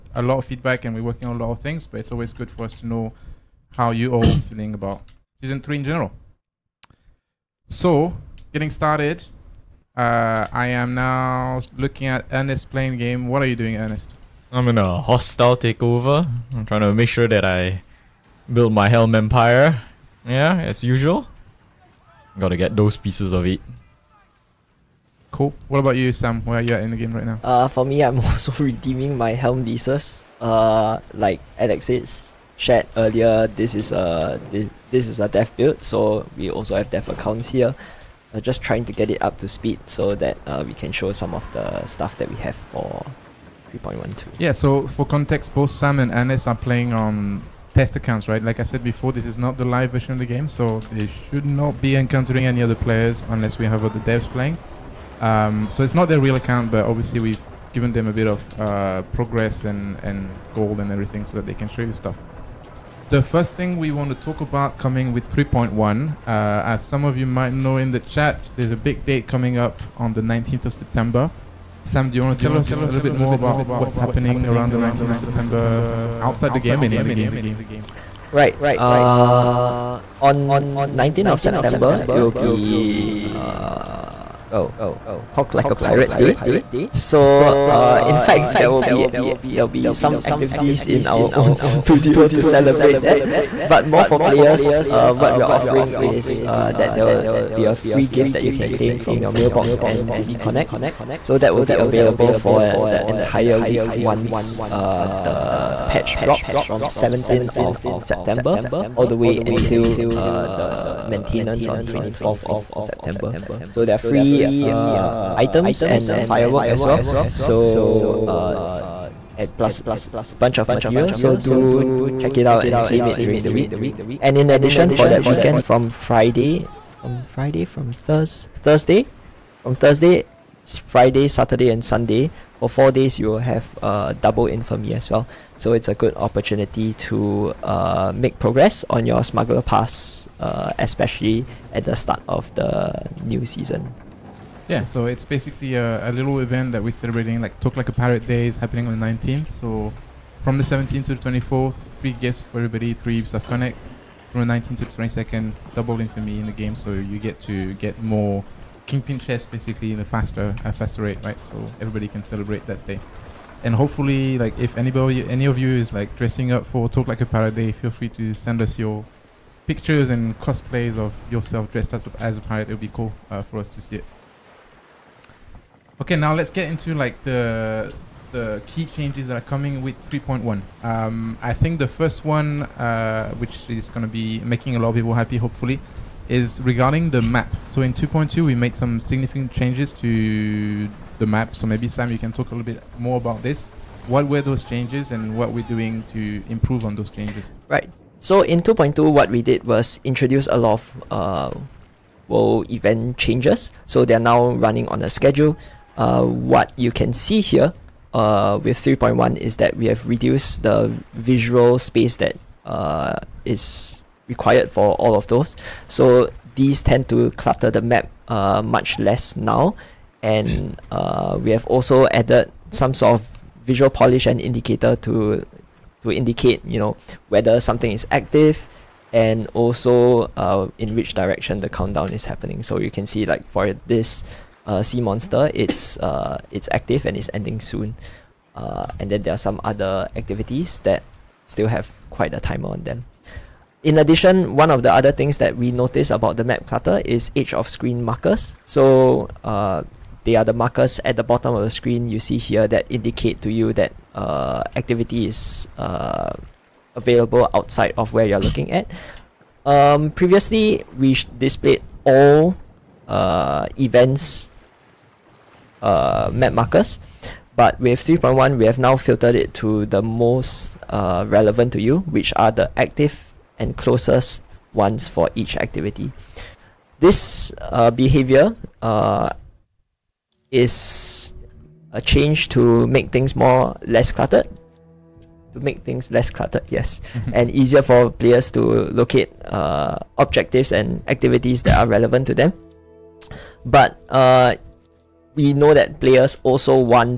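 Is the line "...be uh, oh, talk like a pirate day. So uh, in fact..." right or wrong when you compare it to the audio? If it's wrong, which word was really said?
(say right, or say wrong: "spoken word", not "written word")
right.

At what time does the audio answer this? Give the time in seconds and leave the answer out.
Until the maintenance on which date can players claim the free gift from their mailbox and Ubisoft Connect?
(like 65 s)
111 s.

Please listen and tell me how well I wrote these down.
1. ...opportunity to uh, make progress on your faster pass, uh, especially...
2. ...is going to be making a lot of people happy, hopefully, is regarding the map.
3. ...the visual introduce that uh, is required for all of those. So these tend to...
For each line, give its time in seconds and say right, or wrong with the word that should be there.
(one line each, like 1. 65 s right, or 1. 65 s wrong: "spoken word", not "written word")
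1. 136 s wrong: "smuggler", not "faster"
2. 183 s right
3. 210 s wrong: "space", not "introduce".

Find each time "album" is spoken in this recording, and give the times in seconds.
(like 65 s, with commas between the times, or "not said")
not said.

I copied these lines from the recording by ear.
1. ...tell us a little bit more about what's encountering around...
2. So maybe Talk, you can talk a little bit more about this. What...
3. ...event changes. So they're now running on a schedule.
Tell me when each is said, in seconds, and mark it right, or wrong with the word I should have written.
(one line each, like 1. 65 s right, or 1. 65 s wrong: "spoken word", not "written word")
1. 72 s wrong: "happening", not "encountering"
2. 191 s wrong: "Sam", not "Talk"
3. 202 s right.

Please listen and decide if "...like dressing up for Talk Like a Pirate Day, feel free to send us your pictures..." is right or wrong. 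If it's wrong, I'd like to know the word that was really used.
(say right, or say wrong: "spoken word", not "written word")
right.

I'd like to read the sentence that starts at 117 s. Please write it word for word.
So uh, and plus a bunch of material.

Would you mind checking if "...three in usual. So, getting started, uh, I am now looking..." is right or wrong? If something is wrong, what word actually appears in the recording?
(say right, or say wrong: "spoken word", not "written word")
wrong: "general", not "usual".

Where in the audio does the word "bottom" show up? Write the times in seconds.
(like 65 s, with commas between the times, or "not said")
251 s.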